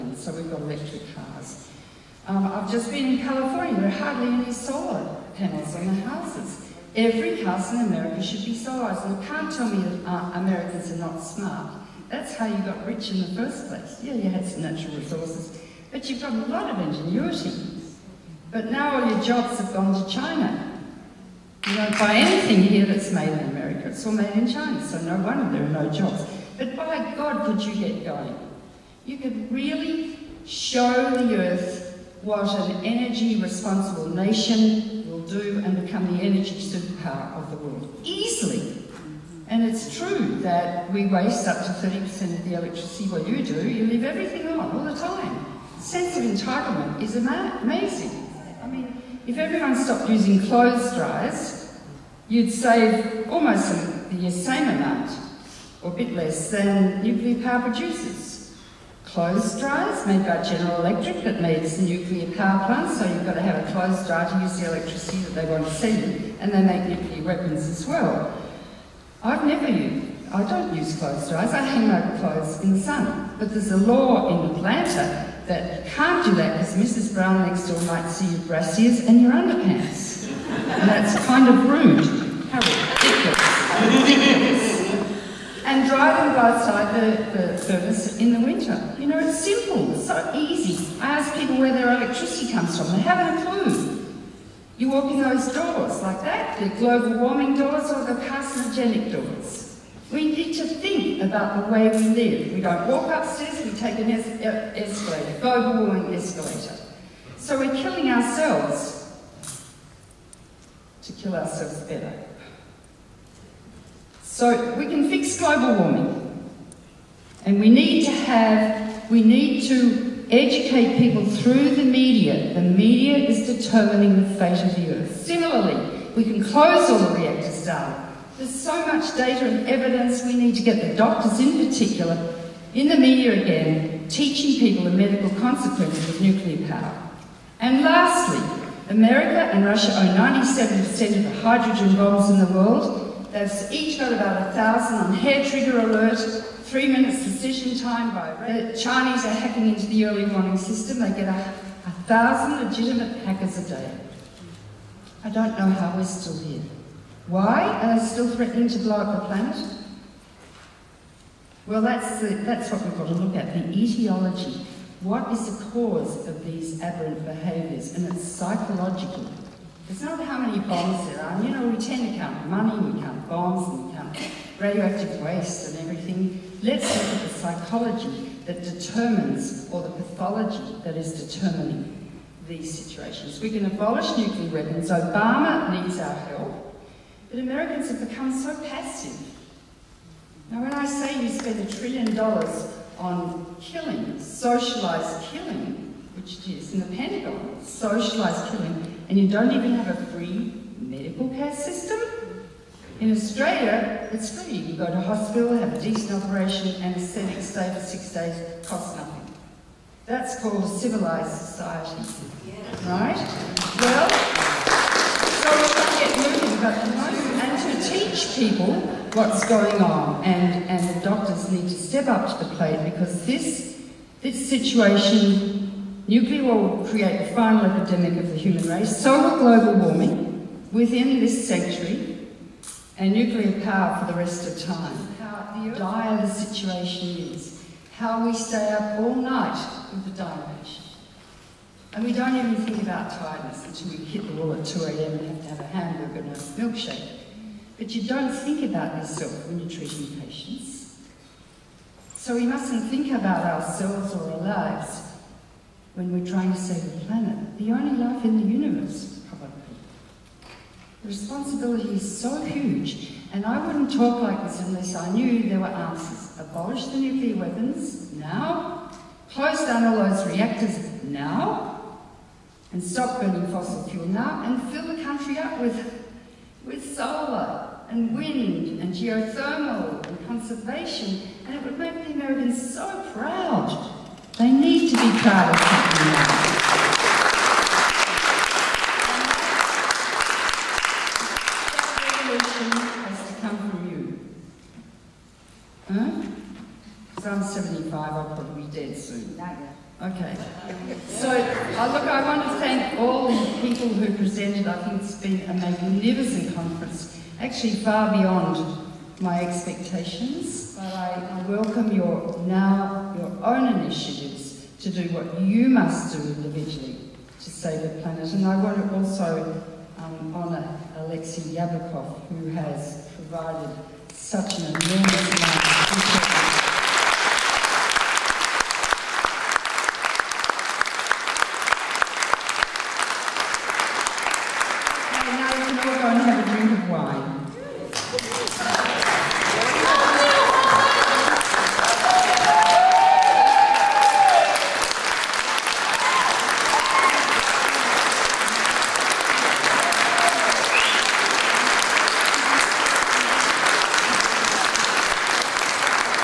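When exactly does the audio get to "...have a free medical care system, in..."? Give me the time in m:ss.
3:19.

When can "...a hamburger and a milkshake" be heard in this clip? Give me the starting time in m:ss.
4:05.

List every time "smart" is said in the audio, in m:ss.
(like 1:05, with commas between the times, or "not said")
0:11.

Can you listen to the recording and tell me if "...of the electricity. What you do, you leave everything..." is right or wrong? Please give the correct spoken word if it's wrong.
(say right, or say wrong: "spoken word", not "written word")
right.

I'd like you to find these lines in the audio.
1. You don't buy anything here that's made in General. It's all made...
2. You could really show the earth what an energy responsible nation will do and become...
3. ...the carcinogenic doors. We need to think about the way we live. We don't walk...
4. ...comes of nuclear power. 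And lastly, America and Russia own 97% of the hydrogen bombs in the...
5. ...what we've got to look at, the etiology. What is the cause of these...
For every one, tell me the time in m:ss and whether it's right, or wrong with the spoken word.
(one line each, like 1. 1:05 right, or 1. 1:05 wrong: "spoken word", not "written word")
1. 0:21 wrong: "America", not "General"
2. 0:29 right
3. 1:38 right
4. 2:15 wrong: "consequences", not "comes"
5. 2:42 right.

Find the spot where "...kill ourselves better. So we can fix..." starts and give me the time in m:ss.
1:51.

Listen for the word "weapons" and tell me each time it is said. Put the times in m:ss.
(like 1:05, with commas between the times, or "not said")
1:07, 3:04, 4:27.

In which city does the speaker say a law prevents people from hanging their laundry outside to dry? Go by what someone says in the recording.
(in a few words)
Atlanta.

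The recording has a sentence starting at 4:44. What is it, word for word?
They need to be proud of something else.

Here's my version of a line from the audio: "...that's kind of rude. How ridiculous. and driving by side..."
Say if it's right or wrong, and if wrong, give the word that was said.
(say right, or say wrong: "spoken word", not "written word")
right.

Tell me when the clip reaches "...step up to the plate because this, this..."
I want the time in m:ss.
3:41.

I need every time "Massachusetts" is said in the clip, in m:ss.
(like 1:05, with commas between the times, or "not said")
not said.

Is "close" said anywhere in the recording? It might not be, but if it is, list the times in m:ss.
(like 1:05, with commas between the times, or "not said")
2:06, 4:29.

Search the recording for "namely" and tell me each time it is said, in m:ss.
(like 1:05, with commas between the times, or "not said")
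not said.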